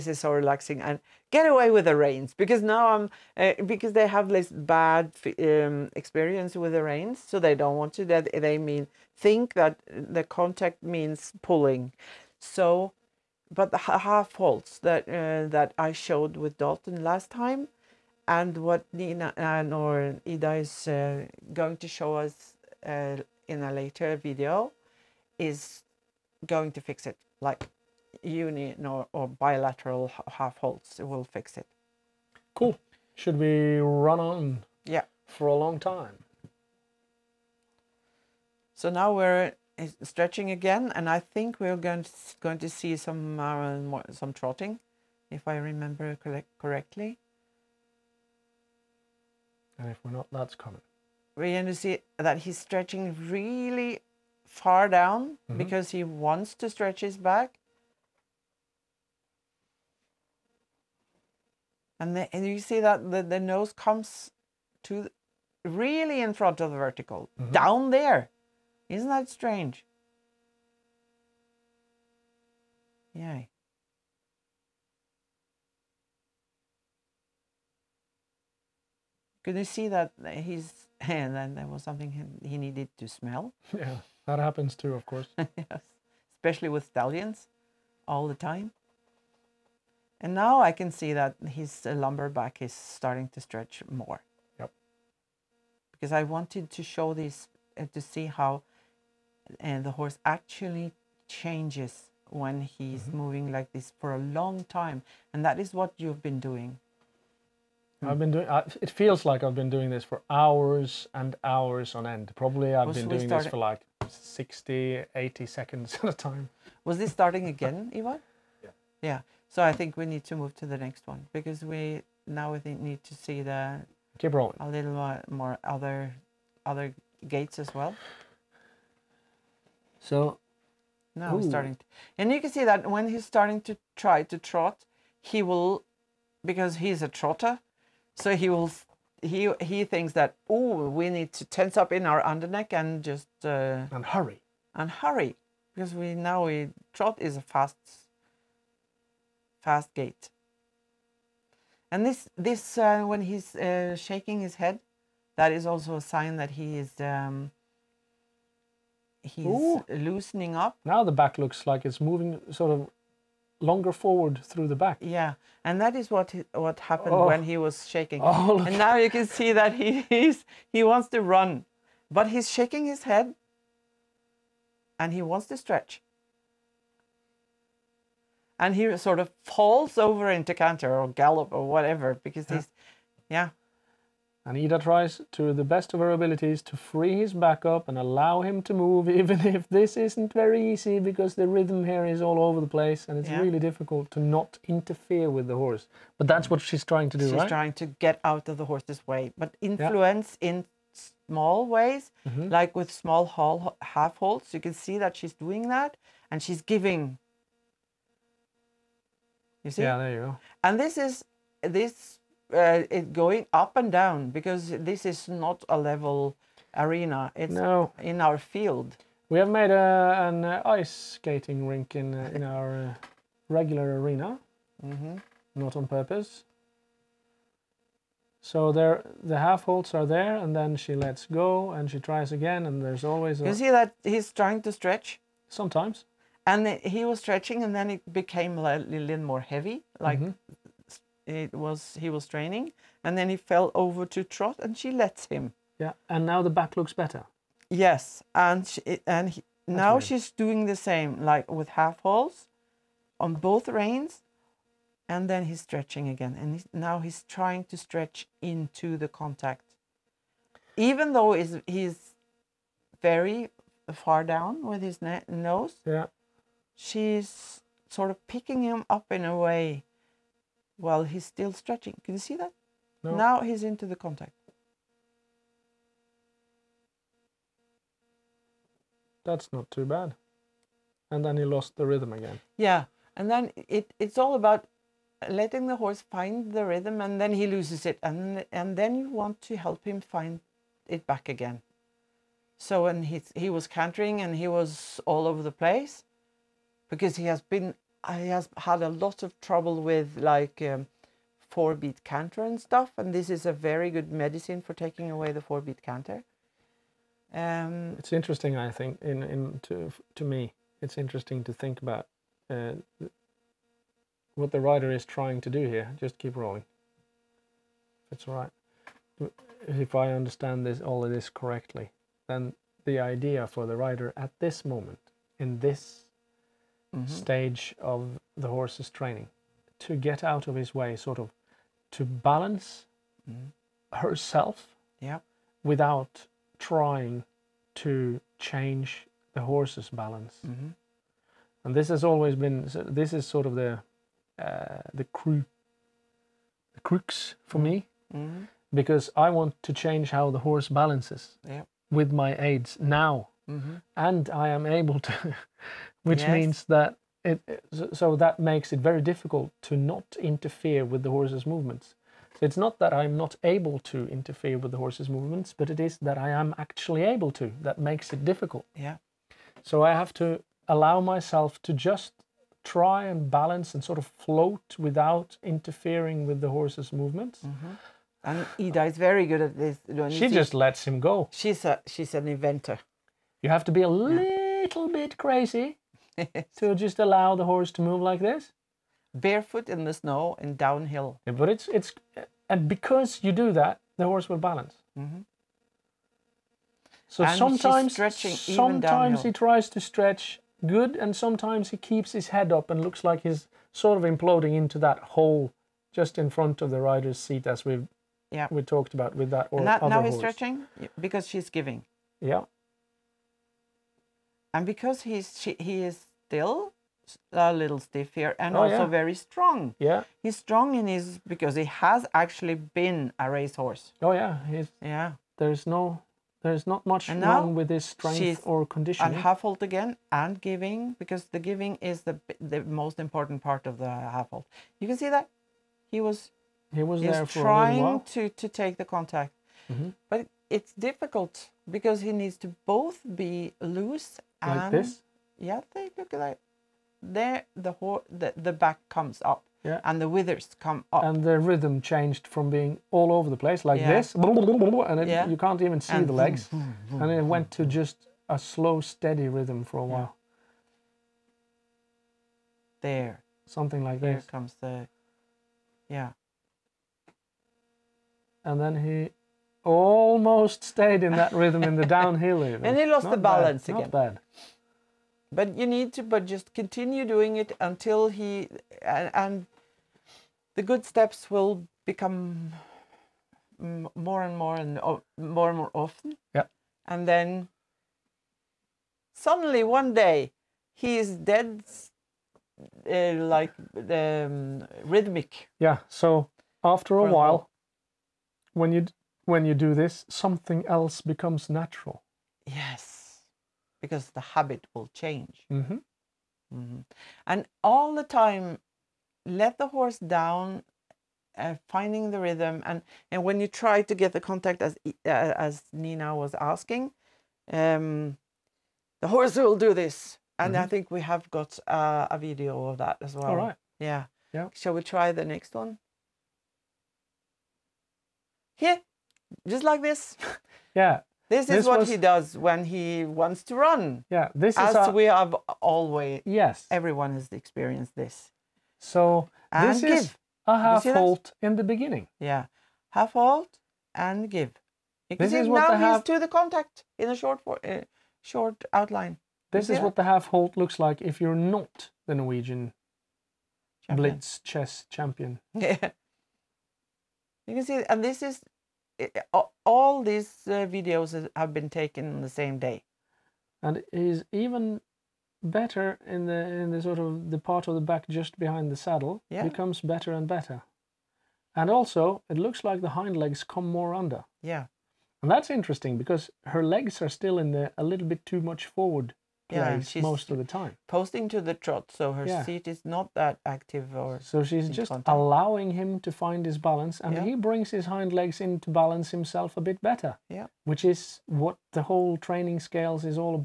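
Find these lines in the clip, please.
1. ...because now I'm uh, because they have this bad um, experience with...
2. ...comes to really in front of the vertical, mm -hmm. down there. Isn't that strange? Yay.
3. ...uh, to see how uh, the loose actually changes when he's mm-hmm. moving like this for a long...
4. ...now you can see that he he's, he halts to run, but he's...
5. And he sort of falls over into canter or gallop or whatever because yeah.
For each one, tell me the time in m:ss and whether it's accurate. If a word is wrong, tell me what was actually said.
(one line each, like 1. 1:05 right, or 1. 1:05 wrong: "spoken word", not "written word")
1. 0:02 right
2. 1:03 right
3. 1:37 wrong: "horse", not "loose"
4. 2:48 wrong: "wants", not "halts"
5. 2:58 right.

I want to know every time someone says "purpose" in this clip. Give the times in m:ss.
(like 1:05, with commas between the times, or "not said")
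3:45.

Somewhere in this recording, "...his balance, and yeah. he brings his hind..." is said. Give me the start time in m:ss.
9:46.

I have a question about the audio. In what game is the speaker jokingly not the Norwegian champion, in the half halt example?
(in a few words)
Blitz chess.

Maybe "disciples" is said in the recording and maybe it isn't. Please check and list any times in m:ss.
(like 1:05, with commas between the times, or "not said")
not said.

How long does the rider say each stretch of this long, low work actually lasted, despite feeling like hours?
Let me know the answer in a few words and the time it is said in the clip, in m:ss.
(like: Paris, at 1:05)
60 to 80 seconds, at 1:54.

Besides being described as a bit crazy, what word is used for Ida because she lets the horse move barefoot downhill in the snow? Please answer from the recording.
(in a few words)
An inventor.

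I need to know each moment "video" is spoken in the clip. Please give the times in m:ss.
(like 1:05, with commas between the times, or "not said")
0:24, 8:42, 9:20.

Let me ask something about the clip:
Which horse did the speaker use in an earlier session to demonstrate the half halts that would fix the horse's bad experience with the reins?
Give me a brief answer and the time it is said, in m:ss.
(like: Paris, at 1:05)
Dalton, at 0:16.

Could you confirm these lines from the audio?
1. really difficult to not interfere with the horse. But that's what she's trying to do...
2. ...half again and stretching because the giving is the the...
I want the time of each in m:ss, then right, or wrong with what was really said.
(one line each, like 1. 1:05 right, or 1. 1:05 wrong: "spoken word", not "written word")
1. 3:13 right
2. 7:09 wrong: "giving", not "stretching".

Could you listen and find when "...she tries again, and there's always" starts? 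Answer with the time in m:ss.
3:51.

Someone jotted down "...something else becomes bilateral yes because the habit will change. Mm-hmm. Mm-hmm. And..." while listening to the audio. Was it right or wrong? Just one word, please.
wrong.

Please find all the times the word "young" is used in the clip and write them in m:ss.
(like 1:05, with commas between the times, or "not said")
not said.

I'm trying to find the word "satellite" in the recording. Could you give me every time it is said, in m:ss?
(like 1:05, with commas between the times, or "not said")
not said.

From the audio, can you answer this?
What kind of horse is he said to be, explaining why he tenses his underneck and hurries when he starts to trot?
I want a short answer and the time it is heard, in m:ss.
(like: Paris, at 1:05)
A trotter, at 2:17.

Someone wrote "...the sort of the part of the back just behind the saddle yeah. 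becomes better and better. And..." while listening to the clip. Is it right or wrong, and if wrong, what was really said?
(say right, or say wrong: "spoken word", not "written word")
right.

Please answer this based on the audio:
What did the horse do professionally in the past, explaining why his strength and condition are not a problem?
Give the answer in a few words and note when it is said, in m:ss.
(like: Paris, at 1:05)
Racehorse, at 7:03.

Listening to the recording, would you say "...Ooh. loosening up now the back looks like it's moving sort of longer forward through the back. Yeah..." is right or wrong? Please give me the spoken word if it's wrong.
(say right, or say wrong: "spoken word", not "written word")
right.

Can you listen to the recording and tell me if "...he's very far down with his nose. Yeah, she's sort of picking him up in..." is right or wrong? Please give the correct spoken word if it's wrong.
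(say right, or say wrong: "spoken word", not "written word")
right.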